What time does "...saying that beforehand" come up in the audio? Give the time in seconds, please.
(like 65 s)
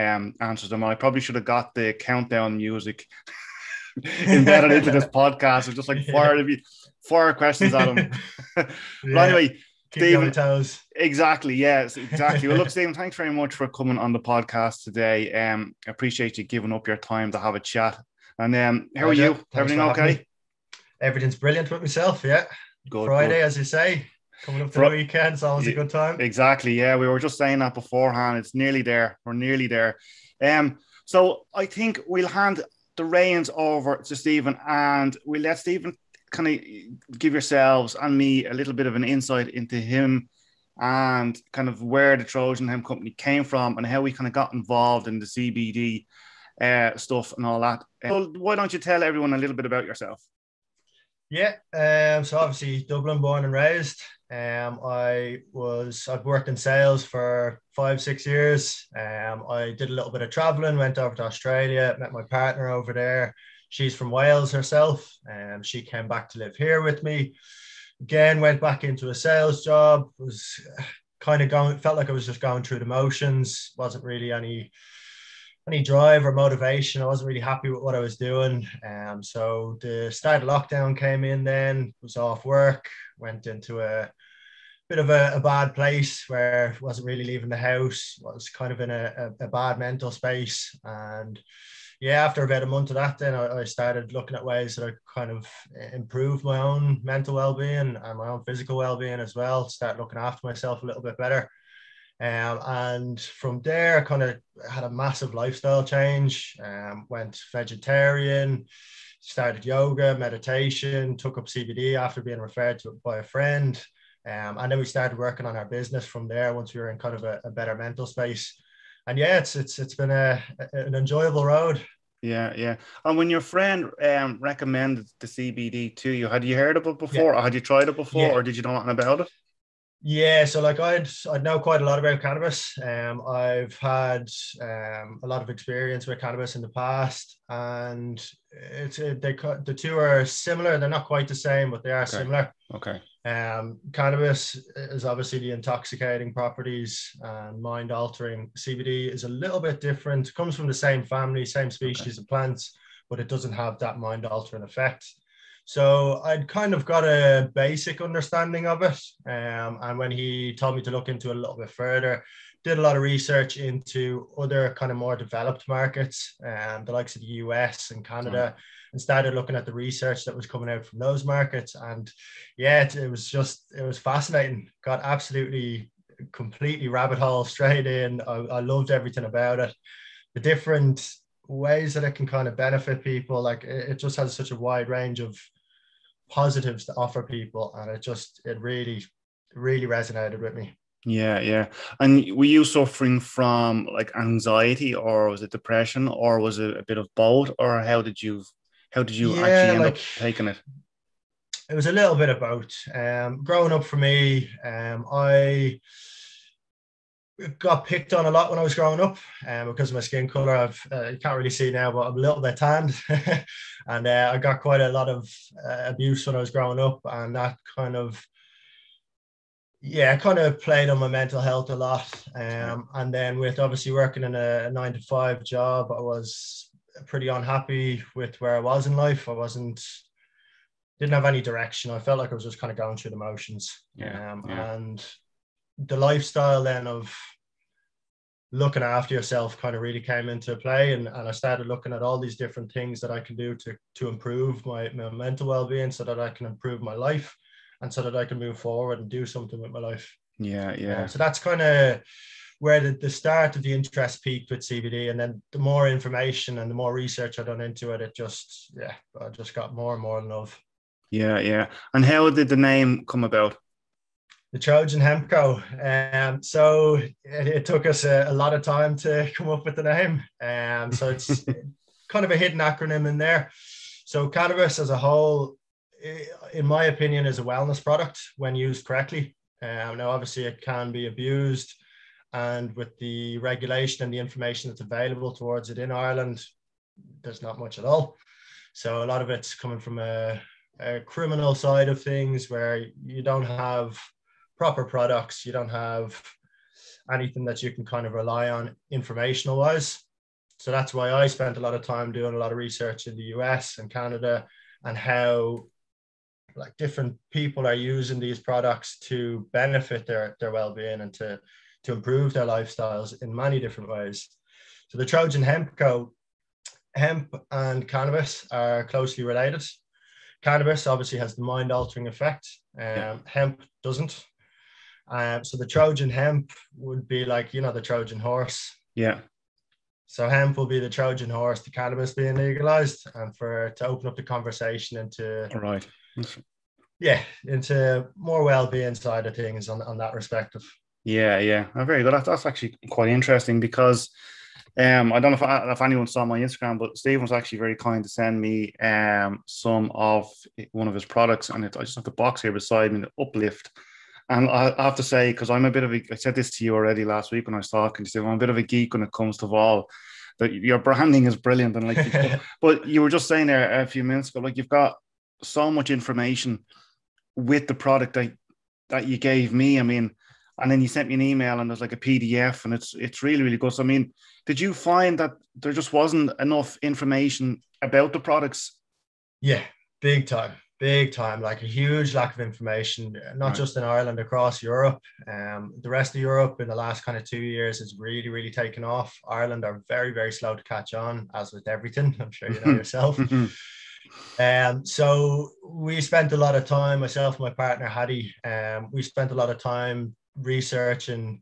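27 s.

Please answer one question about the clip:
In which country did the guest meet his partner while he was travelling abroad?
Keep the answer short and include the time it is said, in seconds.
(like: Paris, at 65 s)
Australia, at 61 s.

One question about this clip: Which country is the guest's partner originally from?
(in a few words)
Wales.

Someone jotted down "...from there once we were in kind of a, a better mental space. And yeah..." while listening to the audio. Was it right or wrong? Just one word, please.
right.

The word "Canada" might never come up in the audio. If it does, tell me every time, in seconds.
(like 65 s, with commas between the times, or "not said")
168 s, 303 s.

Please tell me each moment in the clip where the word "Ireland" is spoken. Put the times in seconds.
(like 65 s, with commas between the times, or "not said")
285 s, 383 s, 389 s.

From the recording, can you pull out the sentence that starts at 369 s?
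I mean, and then you sent me an email, and there's like a PDF, and it's it's really really good.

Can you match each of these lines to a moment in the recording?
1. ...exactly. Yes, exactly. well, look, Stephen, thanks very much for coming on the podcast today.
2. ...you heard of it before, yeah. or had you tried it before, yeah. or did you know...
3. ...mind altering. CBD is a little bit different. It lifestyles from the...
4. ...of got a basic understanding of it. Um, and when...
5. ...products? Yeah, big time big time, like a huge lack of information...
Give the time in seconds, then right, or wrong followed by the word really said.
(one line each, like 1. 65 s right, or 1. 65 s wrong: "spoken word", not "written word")
1. 10 s right
2. 126 s right
3. 147 s wrong: "comes", not "lifestyles"
4. 156 s right
5. 378 s right.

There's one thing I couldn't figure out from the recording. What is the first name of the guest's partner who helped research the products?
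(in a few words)
Hattie.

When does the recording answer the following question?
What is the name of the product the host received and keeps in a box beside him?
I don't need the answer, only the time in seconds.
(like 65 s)
353 s.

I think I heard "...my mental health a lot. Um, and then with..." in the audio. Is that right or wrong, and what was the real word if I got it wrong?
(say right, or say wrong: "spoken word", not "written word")
right.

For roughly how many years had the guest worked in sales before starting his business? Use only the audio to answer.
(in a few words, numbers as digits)
5-6 years.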